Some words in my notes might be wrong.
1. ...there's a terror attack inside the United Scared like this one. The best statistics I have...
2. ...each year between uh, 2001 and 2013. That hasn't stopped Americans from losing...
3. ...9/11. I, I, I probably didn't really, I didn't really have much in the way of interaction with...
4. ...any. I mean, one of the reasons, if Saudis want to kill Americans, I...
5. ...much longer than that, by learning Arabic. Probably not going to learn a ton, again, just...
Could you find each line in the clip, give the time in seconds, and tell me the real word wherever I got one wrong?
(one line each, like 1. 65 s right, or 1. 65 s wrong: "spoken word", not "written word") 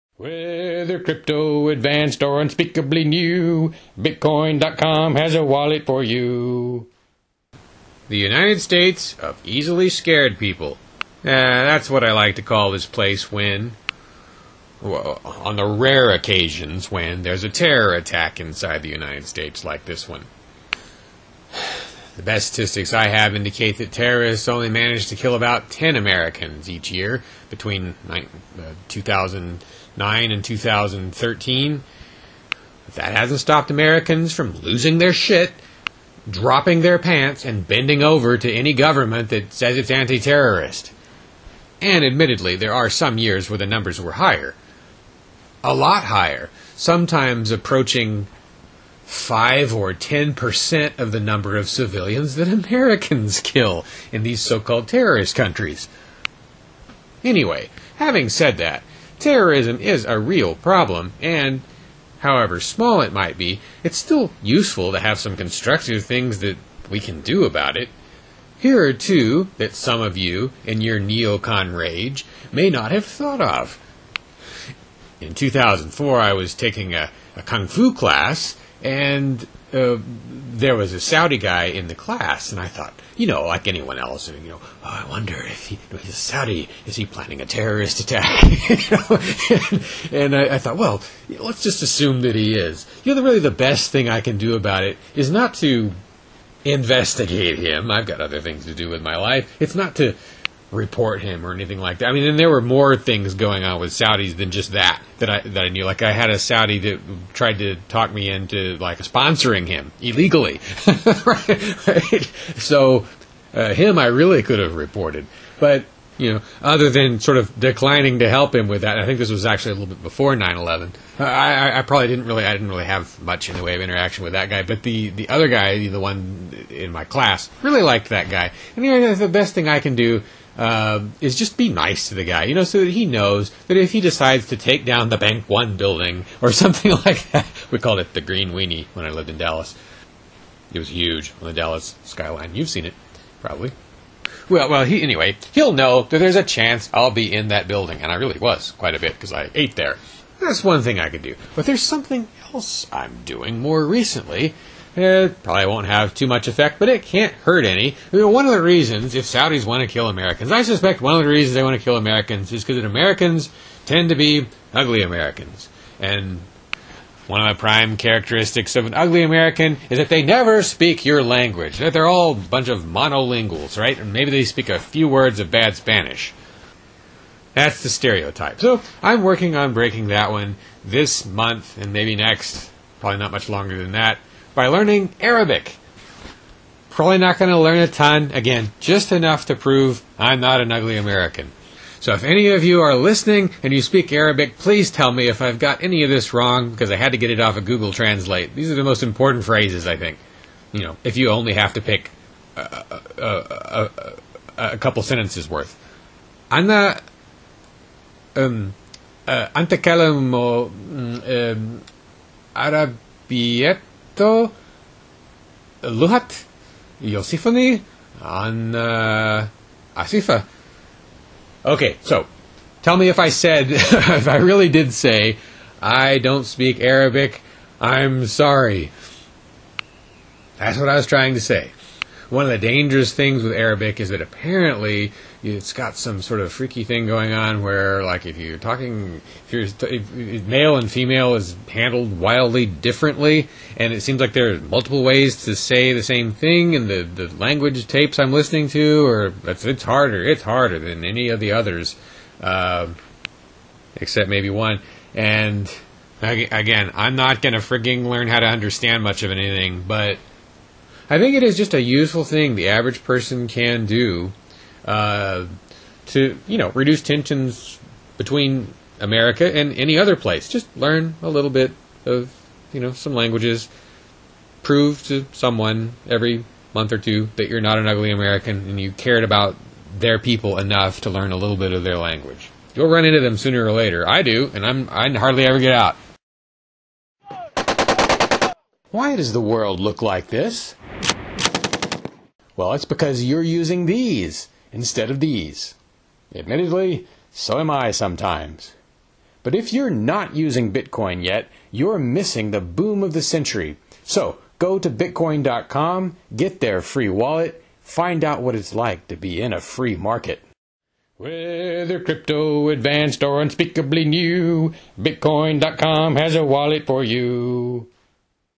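1. 17 s wrong: "States", not "Scared"
2. 26 s wrong: "2000", not "2001"
3. 120 s right
4. 157 s right
5. 183 s right.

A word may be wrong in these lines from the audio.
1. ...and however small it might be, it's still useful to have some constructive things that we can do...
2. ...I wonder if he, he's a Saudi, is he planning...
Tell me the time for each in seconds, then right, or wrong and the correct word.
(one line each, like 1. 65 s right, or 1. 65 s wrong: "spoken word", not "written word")
1. 61 s right
2. 84 s right.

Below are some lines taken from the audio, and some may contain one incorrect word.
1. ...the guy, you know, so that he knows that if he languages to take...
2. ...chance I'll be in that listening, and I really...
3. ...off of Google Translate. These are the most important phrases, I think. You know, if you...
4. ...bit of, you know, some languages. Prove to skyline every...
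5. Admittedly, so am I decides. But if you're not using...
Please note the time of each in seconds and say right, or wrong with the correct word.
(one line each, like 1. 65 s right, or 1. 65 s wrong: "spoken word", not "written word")
1. 132 s wrong: "decides", not "languages"
2. 146 s wrong: "building", not "listening"
3. 197 s right
4. 271 s wrong: "someone", not "skyline"
5. 296 s wrong: "sometimes", not "decides".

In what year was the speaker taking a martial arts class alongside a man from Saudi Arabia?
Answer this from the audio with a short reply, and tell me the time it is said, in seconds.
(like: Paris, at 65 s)
2004, at 75 s.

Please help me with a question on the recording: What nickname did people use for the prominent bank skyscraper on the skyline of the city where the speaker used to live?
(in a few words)
Green Weenie.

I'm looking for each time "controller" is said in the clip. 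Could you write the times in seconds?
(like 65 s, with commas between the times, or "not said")
not said.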